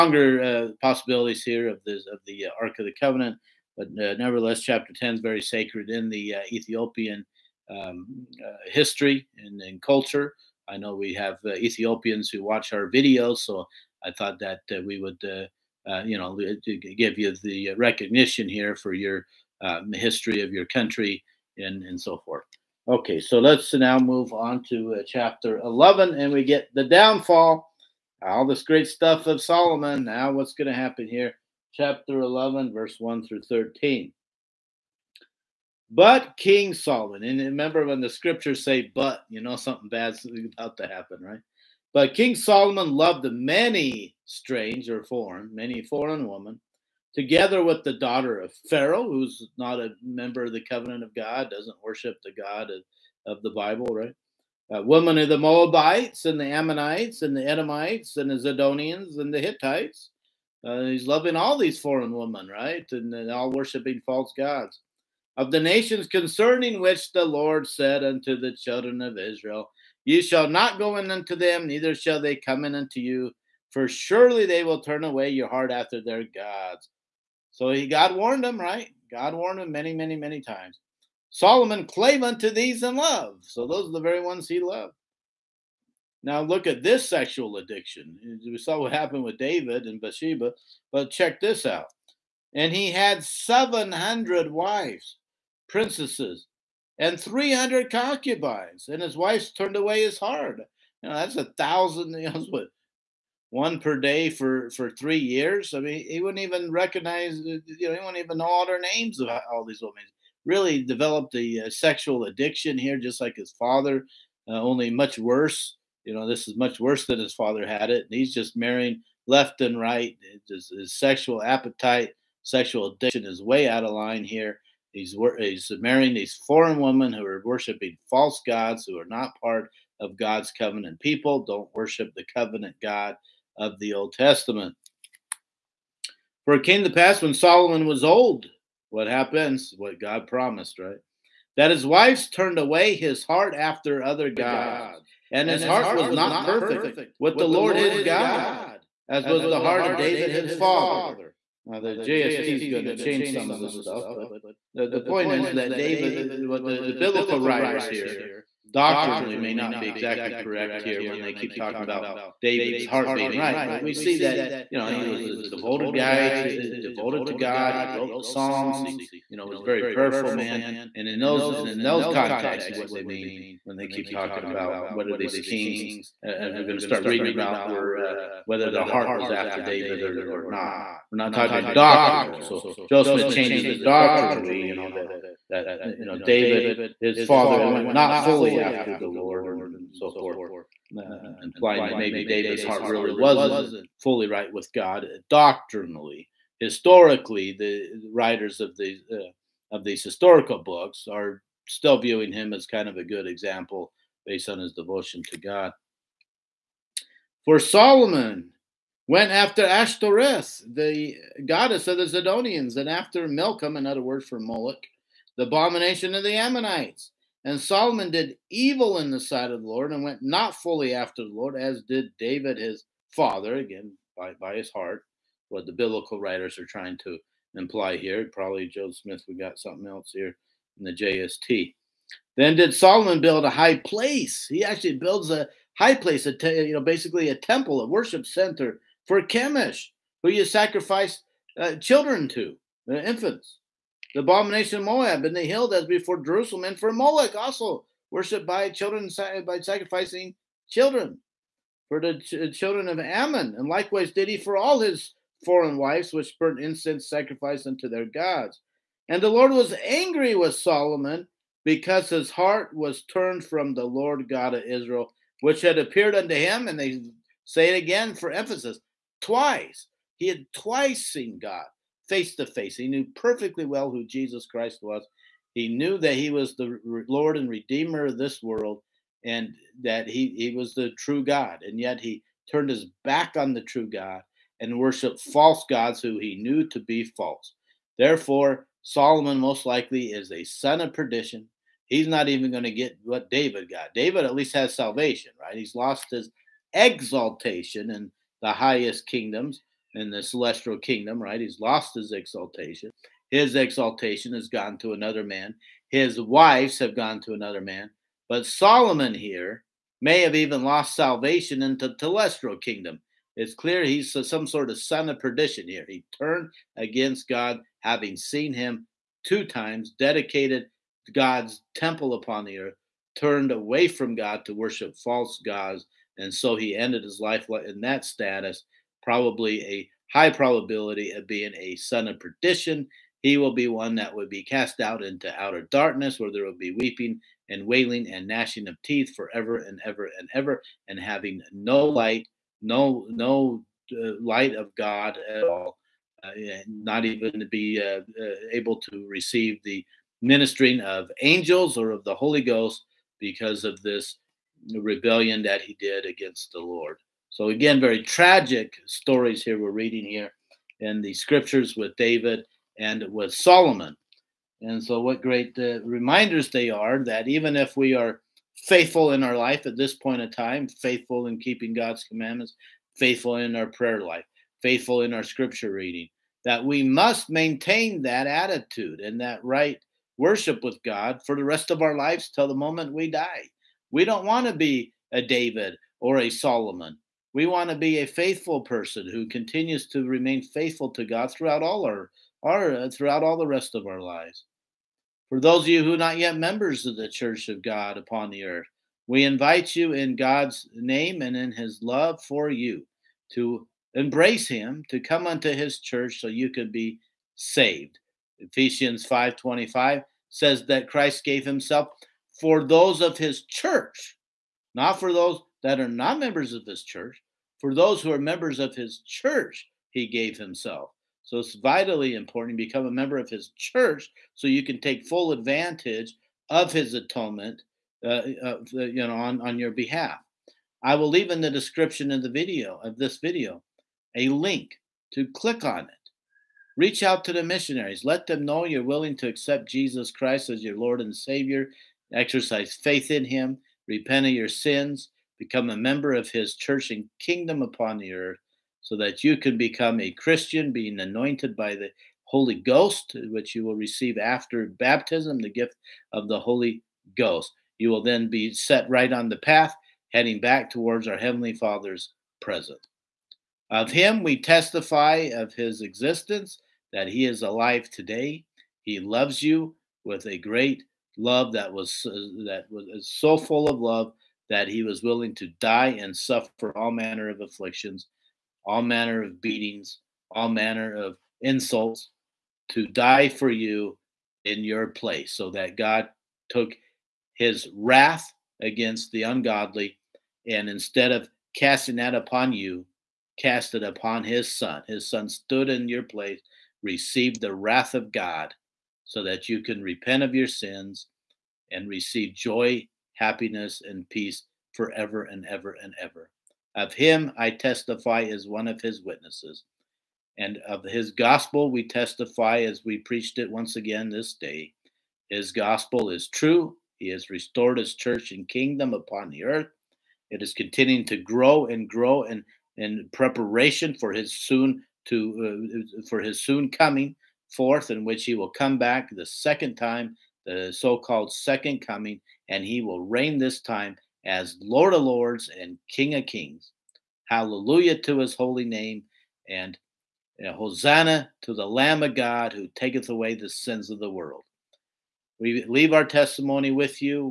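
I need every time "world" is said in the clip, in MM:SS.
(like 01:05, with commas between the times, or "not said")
04:38, 09:04.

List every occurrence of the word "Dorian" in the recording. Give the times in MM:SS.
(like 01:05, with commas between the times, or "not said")
not said.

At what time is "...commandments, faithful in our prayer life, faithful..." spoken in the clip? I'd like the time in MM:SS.
06:12.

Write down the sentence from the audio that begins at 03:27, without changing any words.
For Solomon, went after Ashtoreth, the goddess of the Zidonians, and after Milcom, another word for Moloch, the abomination of the Ammonites.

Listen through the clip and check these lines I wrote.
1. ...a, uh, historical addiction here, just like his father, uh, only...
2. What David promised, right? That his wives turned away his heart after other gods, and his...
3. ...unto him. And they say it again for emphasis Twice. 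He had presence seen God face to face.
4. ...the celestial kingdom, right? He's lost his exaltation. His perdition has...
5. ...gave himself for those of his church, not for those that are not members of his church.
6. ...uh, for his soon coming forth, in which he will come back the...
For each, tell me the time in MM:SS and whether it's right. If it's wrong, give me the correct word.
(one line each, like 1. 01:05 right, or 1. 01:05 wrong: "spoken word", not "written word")
1. 01:51 wrong: "sexual", not "historical"
2. 02:19 wrong: "God", not "David"
3. 04:26 wrong: "twice", not "presence"
4. 05:00 wrong: "exaltation", not "perdition"
5. 06:51 right
6. 08:45 right.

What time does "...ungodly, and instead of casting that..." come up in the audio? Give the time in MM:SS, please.
08:09.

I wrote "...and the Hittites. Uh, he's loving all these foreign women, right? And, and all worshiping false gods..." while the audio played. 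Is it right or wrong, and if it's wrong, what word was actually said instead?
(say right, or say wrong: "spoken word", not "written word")
right.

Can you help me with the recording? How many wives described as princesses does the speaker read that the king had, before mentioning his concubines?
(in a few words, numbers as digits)
700.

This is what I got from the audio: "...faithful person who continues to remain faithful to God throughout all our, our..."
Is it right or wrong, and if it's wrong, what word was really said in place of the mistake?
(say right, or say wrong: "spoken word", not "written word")
right.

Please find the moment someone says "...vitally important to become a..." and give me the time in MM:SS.
07:01.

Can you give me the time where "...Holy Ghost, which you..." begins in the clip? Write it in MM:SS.
07:32.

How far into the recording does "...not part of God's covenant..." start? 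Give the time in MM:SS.
02:09.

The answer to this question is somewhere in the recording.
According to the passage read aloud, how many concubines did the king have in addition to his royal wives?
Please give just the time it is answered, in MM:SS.
01:37.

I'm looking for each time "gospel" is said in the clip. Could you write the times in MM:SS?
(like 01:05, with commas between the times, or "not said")
08:31, 08:35.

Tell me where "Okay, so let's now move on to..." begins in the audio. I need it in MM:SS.
00:22.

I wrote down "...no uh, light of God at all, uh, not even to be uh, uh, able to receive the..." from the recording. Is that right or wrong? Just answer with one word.
right.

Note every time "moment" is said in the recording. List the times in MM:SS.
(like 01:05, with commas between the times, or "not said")
06:22.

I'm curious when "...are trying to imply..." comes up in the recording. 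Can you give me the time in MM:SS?
03:46.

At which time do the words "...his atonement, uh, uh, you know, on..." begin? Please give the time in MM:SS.
07:06.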